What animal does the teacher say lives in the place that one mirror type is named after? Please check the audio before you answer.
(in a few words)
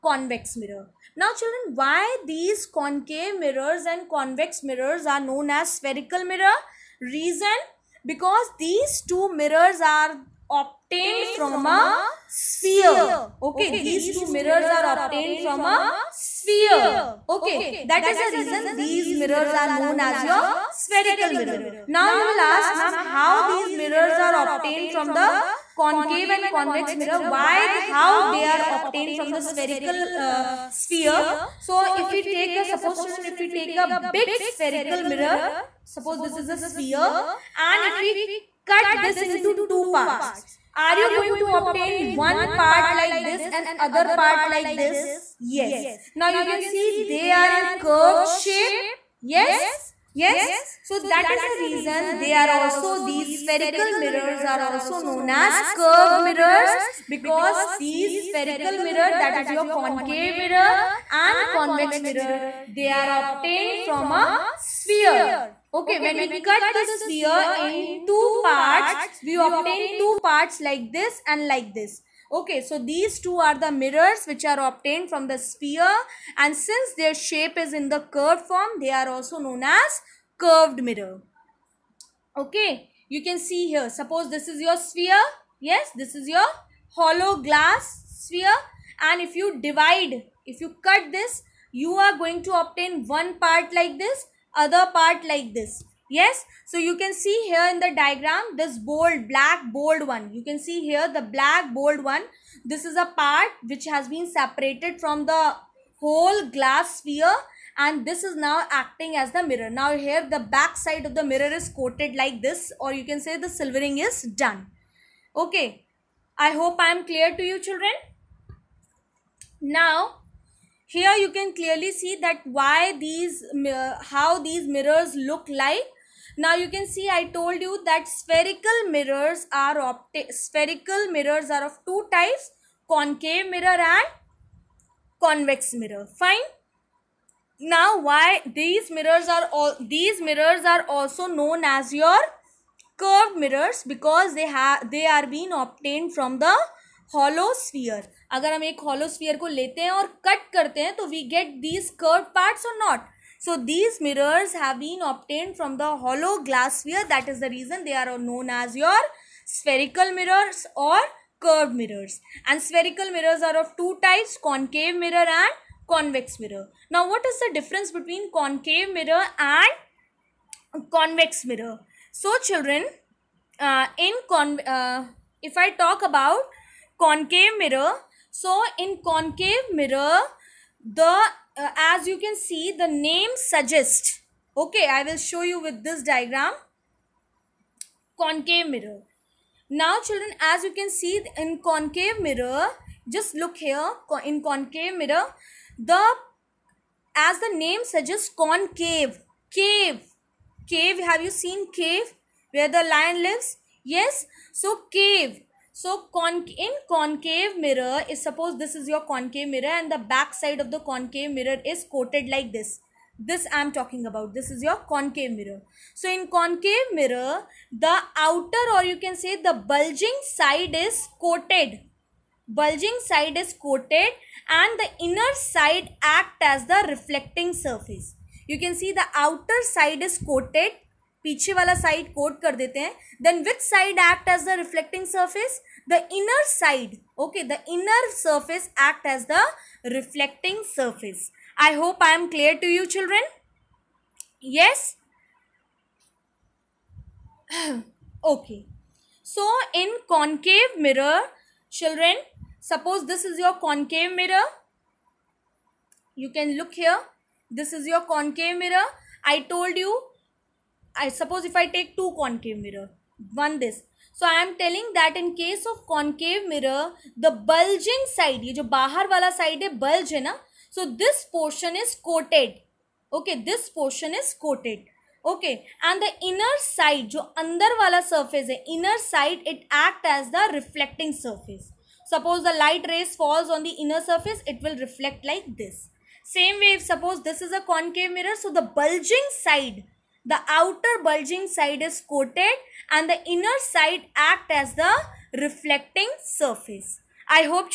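Lion.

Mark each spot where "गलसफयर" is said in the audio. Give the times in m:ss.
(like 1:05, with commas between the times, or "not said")
2:36.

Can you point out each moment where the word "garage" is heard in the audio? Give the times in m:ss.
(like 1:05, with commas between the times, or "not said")
not said.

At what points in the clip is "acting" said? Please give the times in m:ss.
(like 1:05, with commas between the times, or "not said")
1:48.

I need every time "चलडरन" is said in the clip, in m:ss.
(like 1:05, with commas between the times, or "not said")
2:52, 4:02, 4:11.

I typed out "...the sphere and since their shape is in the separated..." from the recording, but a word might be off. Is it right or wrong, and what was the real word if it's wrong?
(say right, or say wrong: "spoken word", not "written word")
wrong: "curved", not "separated".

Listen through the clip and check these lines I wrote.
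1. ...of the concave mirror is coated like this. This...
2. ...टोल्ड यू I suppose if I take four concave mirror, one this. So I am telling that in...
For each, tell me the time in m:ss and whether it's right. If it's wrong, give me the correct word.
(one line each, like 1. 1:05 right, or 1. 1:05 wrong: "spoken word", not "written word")
1. 3:30 right
2. 4:19 wrong: "two", not "four".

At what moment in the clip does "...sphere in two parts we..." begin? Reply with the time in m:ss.
1:06.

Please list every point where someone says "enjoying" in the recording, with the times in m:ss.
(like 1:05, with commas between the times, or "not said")
not said.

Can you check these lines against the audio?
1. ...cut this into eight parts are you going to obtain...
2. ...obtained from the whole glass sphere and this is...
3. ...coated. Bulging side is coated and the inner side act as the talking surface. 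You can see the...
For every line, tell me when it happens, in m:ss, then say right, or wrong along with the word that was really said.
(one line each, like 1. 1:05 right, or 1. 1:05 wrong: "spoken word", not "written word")
1. 0:38 wrong: "two", not "eight"
2. 1:44 wrong: "separated", not "obtained"
3. 3:41 wrong: "reflecting", not "talking".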